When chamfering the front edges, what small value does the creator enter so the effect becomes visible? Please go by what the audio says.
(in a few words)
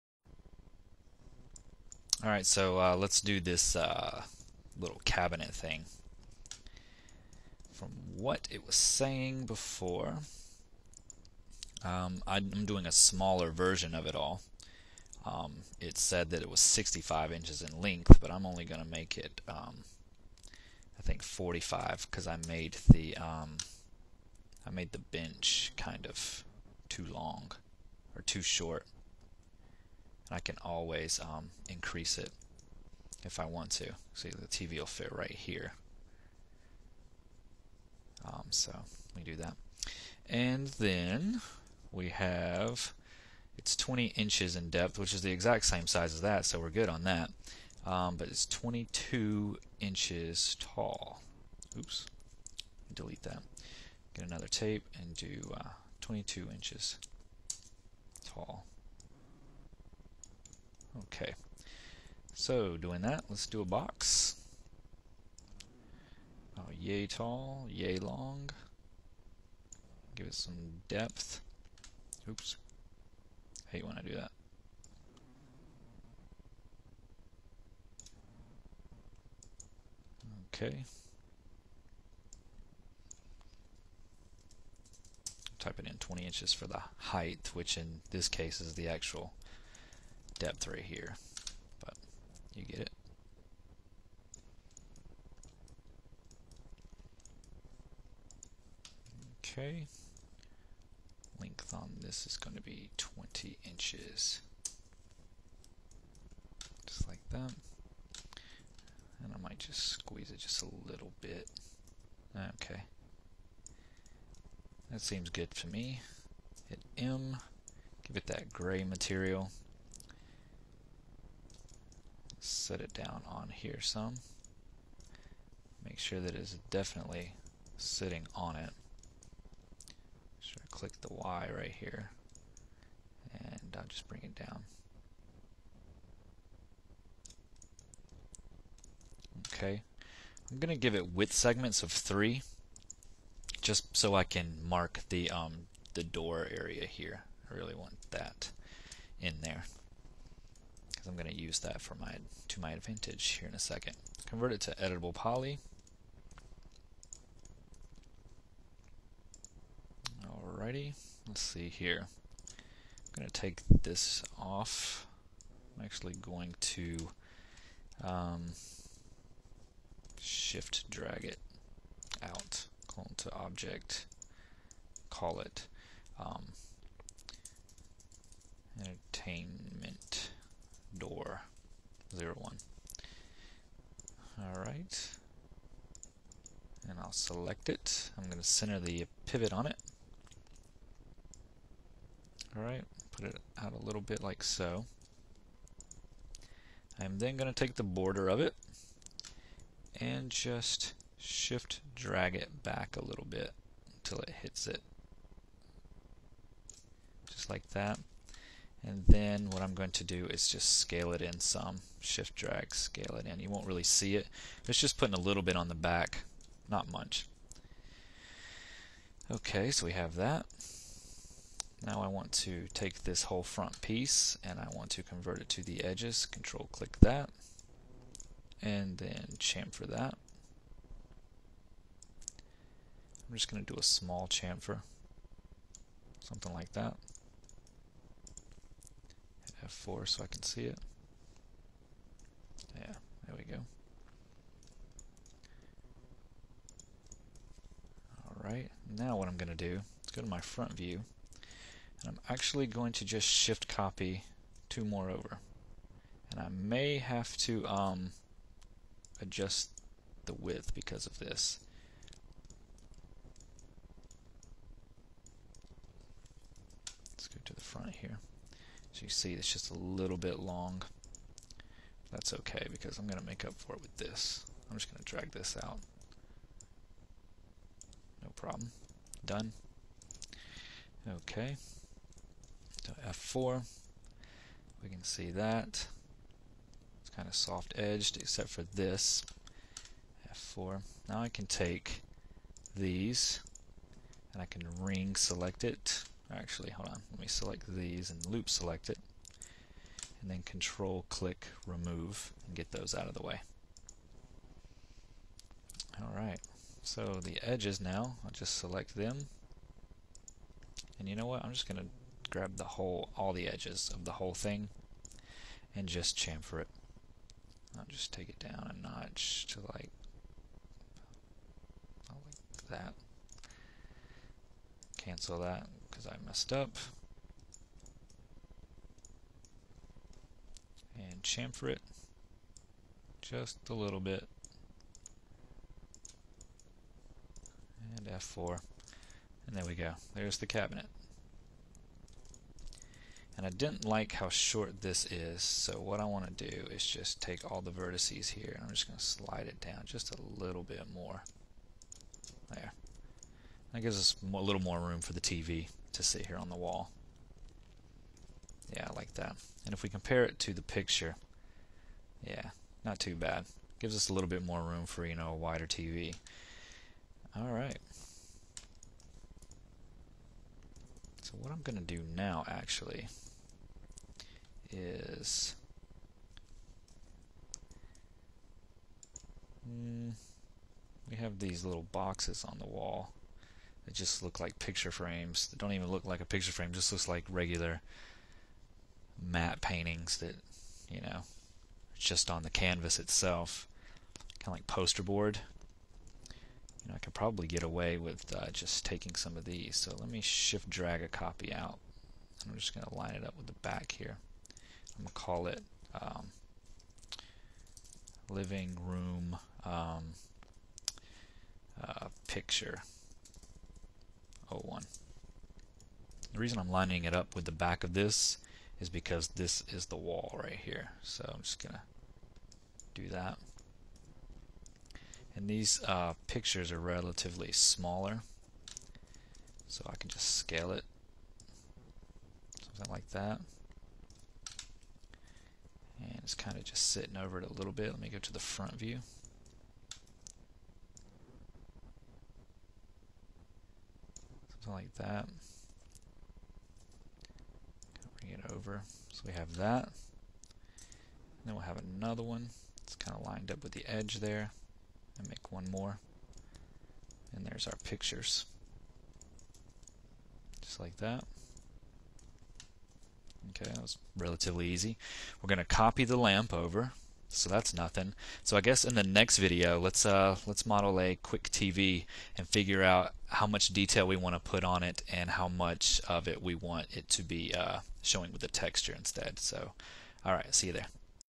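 4.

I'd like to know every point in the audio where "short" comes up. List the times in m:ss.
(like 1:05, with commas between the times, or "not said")
0:28, 5:44.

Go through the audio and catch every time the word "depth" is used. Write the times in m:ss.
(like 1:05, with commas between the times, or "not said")
0:44, 1:10, 1:30.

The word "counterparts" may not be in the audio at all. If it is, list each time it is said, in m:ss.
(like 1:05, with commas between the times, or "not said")
not said.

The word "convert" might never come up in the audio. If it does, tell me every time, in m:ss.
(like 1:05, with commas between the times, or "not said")
2:34, 3:45.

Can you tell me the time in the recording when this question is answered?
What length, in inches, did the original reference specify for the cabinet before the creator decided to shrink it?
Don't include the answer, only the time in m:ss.
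0:16.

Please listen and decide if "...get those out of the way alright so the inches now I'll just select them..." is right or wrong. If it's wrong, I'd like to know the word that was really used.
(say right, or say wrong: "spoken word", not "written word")
wrong: "edges", not "inches".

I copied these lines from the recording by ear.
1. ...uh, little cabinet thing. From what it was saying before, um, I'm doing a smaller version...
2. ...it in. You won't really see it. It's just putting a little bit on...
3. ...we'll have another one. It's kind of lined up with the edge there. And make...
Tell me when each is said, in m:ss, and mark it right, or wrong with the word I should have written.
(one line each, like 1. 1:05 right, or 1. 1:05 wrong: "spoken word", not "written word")
1. 0:03 right
2. 3:33 right
3. 7:31 right.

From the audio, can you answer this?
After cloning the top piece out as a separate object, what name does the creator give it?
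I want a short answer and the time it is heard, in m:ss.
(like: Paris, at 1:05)
entertainment 1, at 2:58.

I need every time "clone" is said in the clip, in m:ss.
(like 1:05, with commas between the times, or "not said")
2:52.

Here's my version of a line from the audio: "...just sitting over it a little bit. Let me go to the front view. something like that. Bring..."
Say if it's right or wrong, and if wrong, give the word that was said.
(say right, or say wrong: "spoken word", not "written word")
right.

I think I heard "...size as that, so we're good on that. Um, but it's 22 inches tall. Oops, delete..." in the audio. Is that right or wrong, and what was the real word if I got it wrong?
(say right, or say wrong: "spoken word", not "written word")
right.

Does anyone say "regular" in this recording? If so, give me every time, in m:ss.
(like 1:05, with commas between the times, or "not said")
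6:27.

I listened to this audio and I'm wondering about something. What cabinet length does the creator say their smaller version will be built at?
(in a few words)
45 inches.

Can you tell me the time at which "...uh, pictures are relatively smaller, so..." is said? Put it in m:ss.
7:05.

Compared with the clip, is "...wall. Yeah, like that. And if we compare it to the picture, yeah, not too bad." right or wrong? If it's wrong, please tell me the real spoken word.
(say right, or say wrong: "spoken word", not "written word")
right.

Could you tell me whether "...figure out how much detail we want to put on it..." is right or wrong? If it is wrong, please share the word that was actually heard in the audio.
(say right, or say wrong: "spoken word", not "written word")
right.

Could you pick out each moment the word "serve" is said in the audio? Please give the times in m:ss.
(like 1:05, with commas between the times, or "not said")
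not said.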